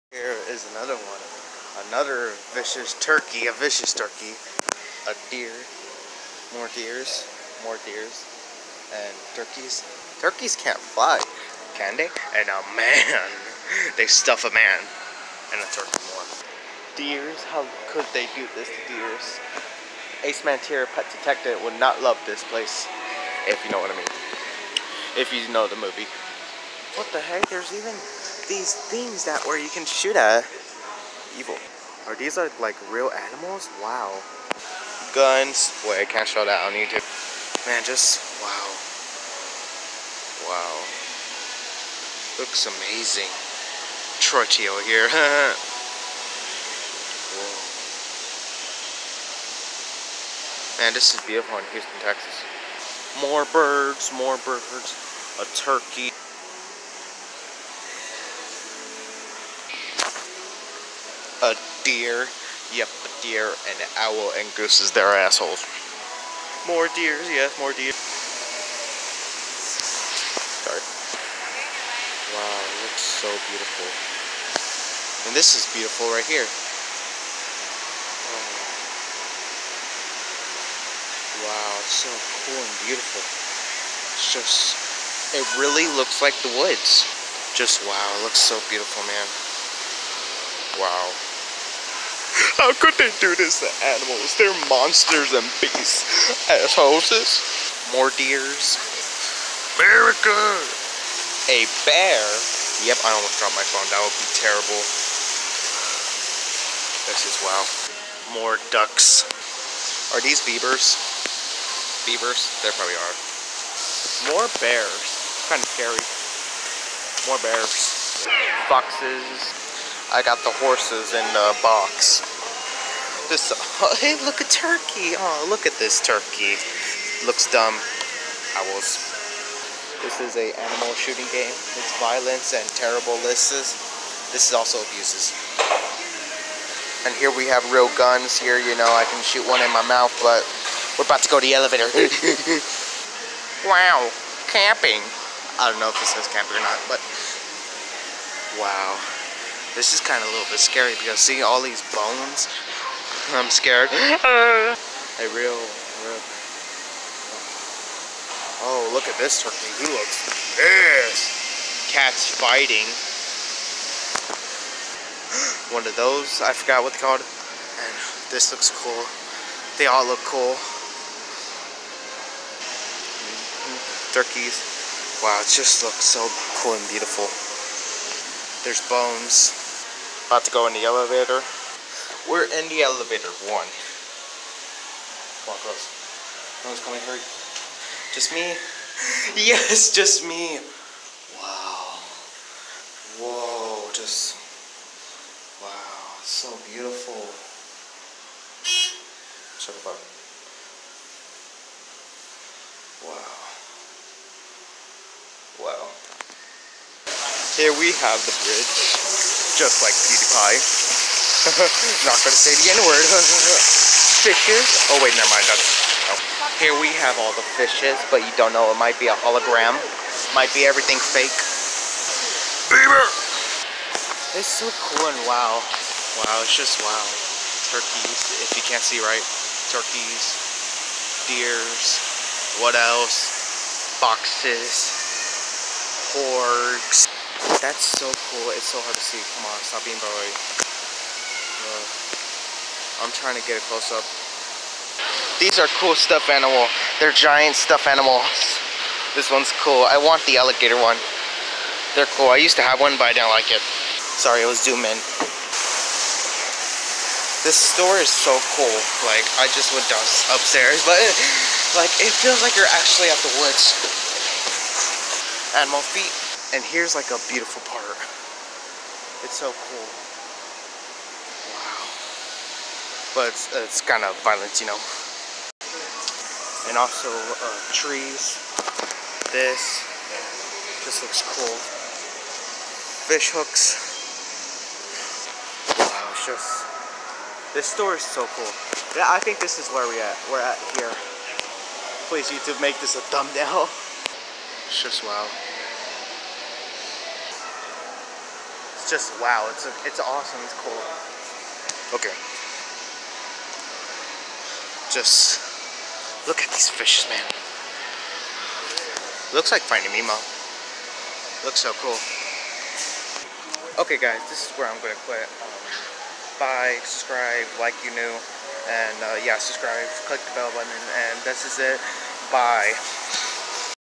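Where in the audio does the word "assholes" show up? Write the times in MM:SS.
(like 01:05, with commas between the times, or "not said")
01:05, 01:36.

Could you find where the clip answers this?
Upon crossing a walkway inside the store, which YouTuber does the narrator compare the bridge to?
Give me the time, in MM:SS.
03:29.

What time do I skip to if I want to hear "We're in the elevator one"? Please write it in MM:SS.
03:02.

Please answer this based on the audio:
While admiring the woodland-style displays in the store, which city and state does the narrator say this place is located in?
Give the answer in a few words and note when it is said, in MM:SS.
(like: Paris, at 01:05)
Houston, Texas, at 00:51.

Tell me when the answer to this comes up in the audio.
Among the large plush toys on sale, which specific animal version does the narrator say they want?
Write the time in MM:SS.
04:10.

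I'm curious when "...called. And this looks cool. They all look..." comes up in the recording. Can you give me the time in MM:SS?
02:46.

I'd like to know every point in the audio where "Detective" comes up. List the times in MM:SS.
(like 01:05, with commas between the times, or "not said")
00:21.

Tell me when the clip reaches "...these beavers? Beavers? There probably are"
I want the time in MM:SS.
01:50.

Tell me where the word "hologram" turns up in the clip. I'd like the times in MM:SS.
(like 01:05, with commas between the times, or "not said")
03:39.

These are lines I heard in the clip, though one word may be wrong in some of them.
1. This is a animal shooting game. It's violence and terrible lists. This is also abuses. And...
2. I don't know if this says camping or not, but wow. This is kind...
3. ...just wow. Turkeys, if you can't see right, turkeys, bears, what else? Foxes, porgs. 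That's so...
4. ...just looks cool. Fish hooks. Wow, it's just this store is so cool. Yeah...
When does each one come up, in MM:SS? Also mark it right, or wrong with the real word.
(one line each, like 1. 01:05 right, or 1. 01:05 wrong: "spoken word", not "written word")
1. 02:10 right
2. 02:25 right
3. 03:46 wrong: "deers", not "bears"
4. 04:40 right.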